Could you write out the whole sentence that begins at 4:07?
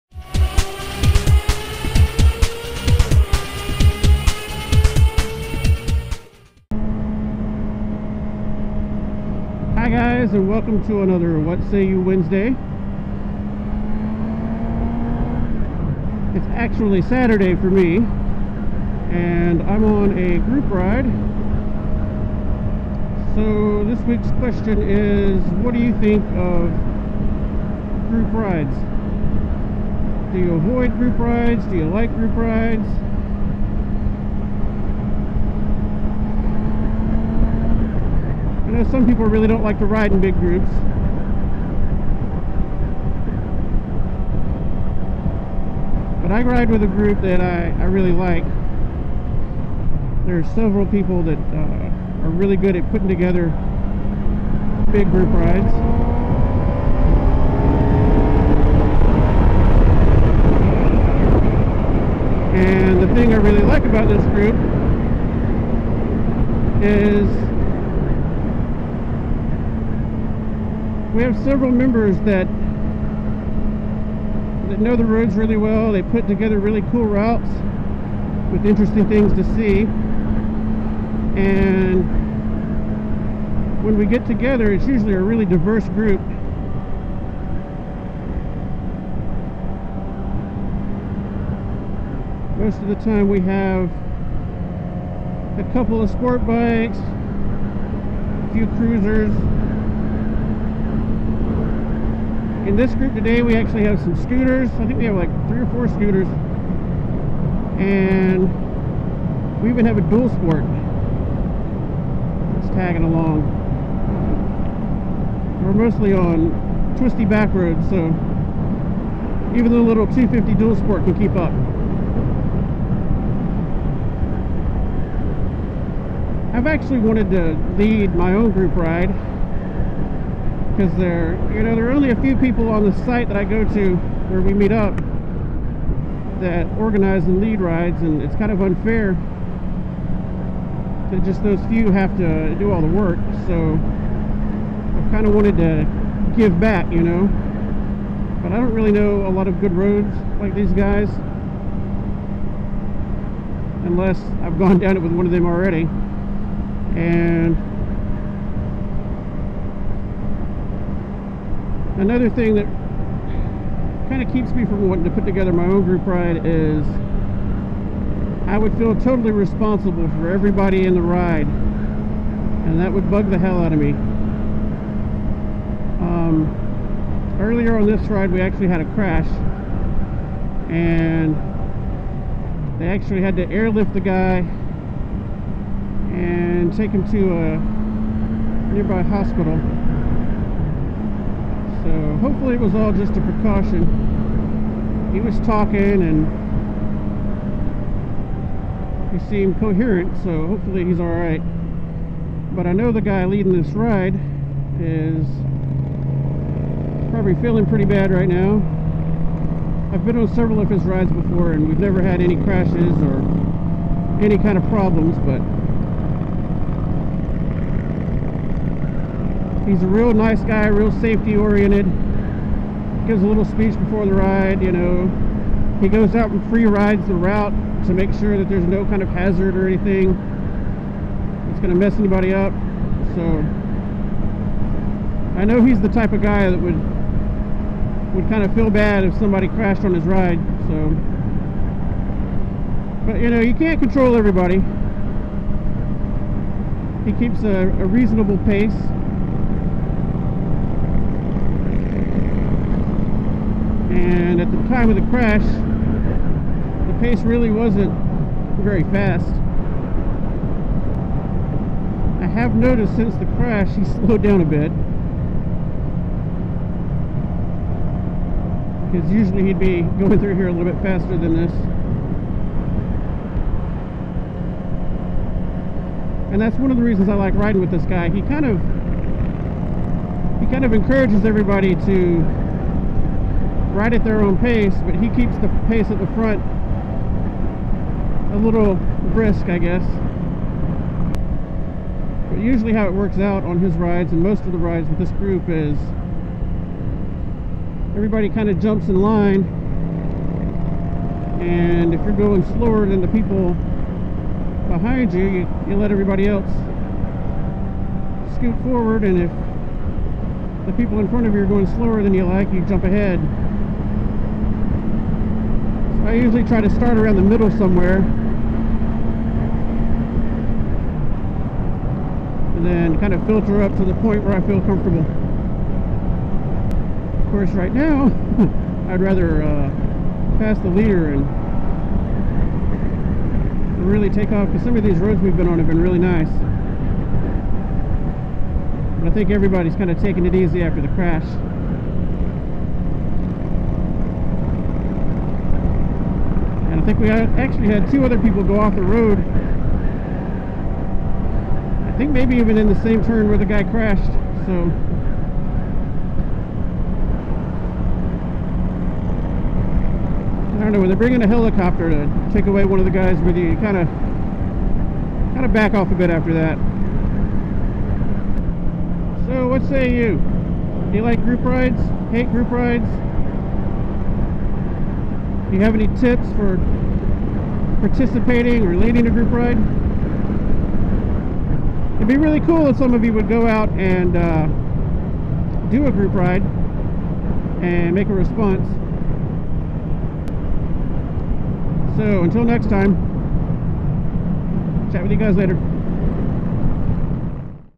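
He keeps a, a reasonable pace.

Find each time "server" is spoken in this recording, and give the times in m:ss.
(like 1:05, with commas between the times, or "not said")
not said.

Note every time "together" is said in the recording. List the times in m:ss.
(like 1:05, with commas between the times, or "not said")
0:53, 1:16, 1:24, 2:45.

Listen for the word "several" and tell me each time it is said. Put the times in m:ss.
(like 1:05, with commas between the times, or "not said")
0:50, 1:11, 3:30.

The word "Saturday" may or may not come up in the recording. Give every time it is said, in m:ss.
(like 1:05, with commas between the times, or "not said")
0:17.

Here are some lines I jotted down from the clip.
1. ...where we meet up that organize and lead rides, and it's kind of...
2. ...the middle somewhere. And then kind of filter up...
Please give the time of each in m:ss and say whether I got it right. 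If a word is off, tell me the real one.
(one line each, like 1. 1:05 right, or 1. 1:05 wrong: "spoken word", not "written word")
1. 2:13 right
2. 5:17 right.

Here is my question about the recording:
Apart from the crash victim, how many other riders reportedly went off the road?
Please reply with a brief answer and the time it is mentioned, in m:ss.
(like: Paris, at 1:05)
2, at 5:47.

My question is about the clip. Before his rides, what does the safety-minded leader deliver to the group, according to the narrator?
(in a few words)
a little speech.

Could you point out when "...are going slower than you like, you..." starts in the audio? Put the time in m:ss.
5:11.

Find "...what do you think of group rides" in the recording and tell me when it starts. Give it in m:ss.
0:25.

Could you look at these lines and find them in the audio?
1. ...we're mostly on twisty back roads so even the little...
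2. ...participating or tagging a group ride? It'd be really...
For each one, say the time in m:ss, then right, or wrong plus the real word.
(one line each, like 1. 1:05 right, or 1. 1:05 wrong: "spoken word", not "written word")
1. 1:55 right
2. 6:17 wrong: "leading", not "tagging".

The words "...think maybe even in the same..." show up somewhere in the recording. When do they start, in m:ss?
5:51.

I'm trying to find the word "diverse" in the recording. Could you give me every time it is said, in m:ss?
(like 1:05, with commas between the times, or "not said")
1:25.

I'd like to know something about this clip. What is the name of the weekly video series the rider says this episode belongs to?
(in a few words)
What Say You Wednesday.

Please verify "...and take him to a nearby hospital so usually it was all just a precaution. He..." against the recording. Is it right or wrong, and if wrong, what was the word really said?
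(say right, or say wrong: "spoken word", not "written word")
wrong: "hopefully", not "usually".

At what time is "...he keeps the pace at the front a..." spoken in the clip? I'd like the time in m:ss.
4:44.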